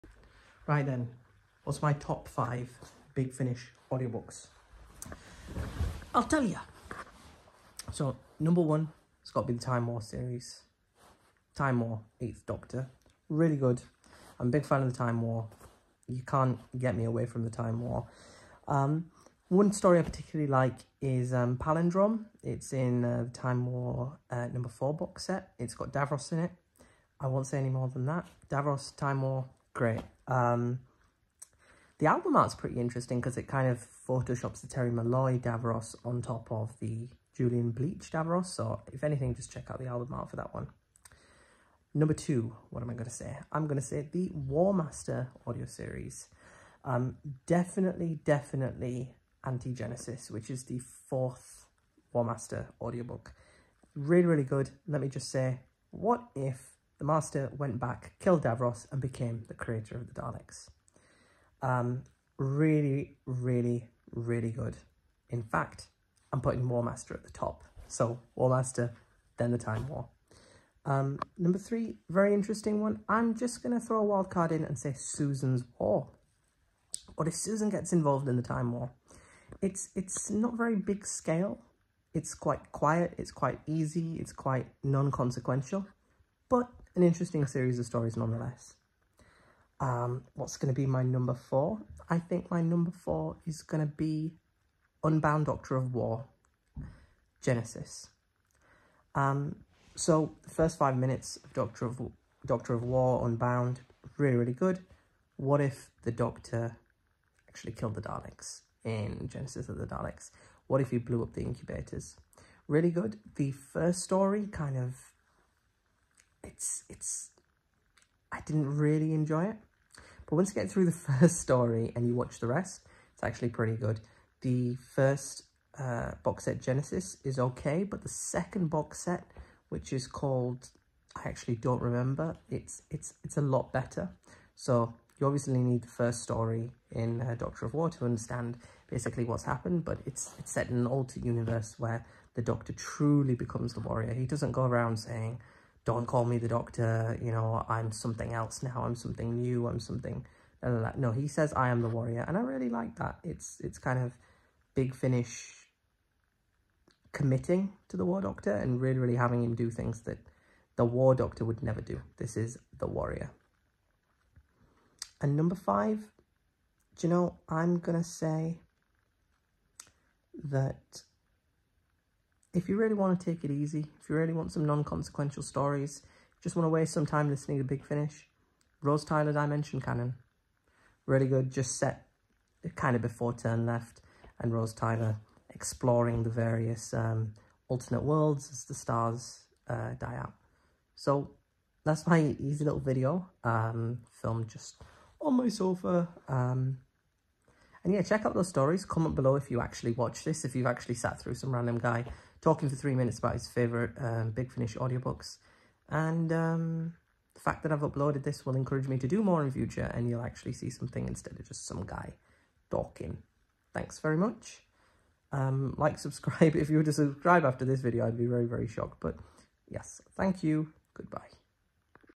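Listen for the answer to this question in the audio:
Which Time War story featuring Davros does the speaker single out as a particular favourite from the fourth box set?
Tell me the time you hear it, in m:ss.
0:21.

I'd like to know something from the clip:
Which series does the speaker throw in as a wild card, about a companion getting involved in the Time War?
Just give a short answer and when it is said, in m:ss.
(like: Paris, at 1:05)
Susan's War, at 1:14.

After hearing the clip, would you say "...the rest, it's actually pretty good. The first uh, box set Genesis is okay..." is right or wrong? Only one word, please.
right.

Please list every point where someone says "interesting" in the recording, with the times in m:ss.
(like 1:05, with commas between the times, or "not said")
0:32, 1:12, 1:27.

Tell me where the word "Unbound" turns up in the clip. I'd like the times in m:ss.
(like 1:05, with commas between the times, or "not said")
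1:35, 1:43.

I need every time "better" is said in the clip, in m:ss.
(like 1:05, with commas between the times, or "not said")
2:13.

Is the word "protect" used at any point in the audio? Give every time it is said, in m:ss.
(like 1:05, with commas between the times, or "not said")
not said.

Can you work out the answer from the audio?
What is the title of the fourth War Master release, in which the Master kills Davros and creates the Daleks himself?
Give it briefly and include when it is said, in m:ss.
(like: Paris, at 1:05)
Anti-Genesis, at 0:49.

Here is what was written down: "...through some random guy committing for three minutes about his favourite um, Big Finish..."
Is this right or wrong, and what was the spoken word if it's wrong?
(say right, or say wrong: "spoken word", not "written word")
wrong: "talking", not "committing".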